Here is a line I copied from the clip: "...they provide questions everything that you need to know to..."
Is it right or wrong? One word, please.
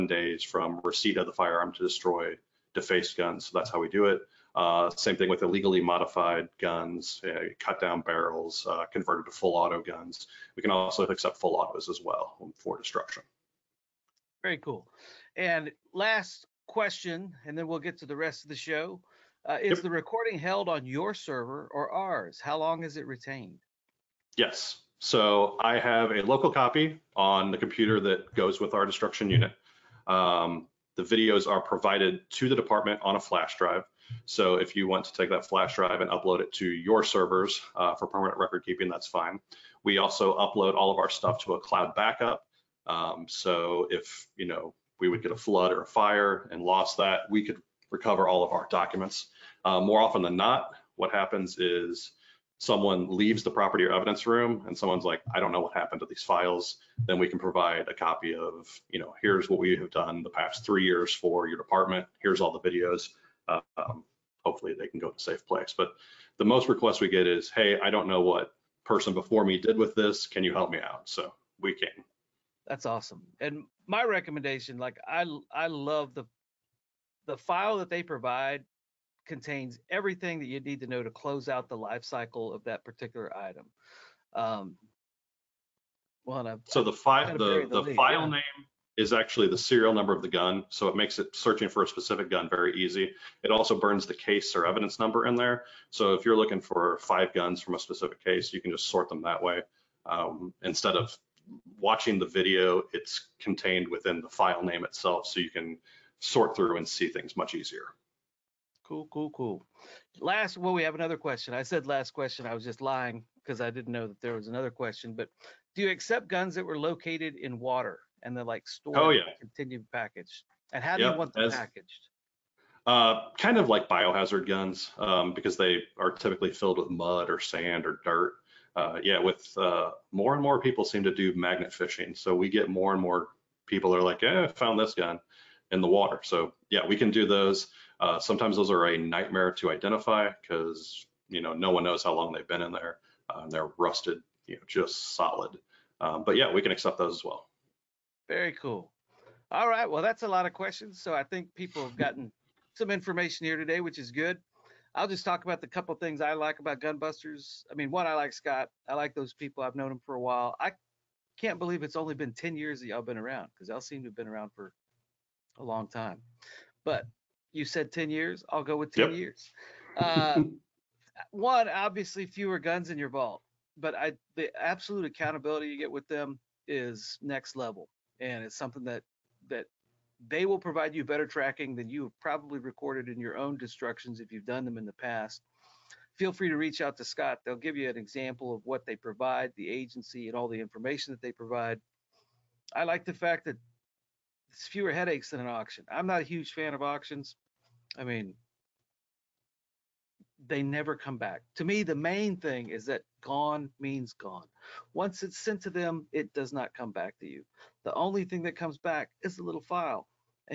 wrong.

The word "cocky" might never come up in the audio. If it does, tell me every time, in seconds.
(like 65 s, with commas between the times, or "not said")
not said.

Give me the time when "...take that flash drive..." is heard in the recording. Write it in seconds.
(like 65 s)
35 s.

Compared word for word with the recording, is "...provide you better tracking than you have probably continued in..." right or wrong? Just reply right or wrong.
wrong.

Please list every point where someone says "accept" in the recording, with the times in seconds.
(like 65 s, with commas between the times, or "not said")
11 s, 115 s, 146 s.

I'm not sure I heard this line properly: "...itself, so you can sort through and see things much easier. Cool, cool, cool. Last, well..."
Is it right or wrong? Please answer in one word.
right.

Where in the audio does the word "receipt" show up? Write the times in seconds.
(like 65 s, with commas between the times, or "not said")
0 s.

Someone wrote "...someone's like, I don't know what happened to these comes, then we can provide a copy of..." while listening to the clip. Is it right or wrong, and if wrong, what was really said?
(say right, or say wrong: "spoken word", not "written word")
wrong: "files", not "comes".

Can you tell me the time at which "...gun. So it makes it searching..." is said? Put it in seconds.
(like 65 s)
90 s.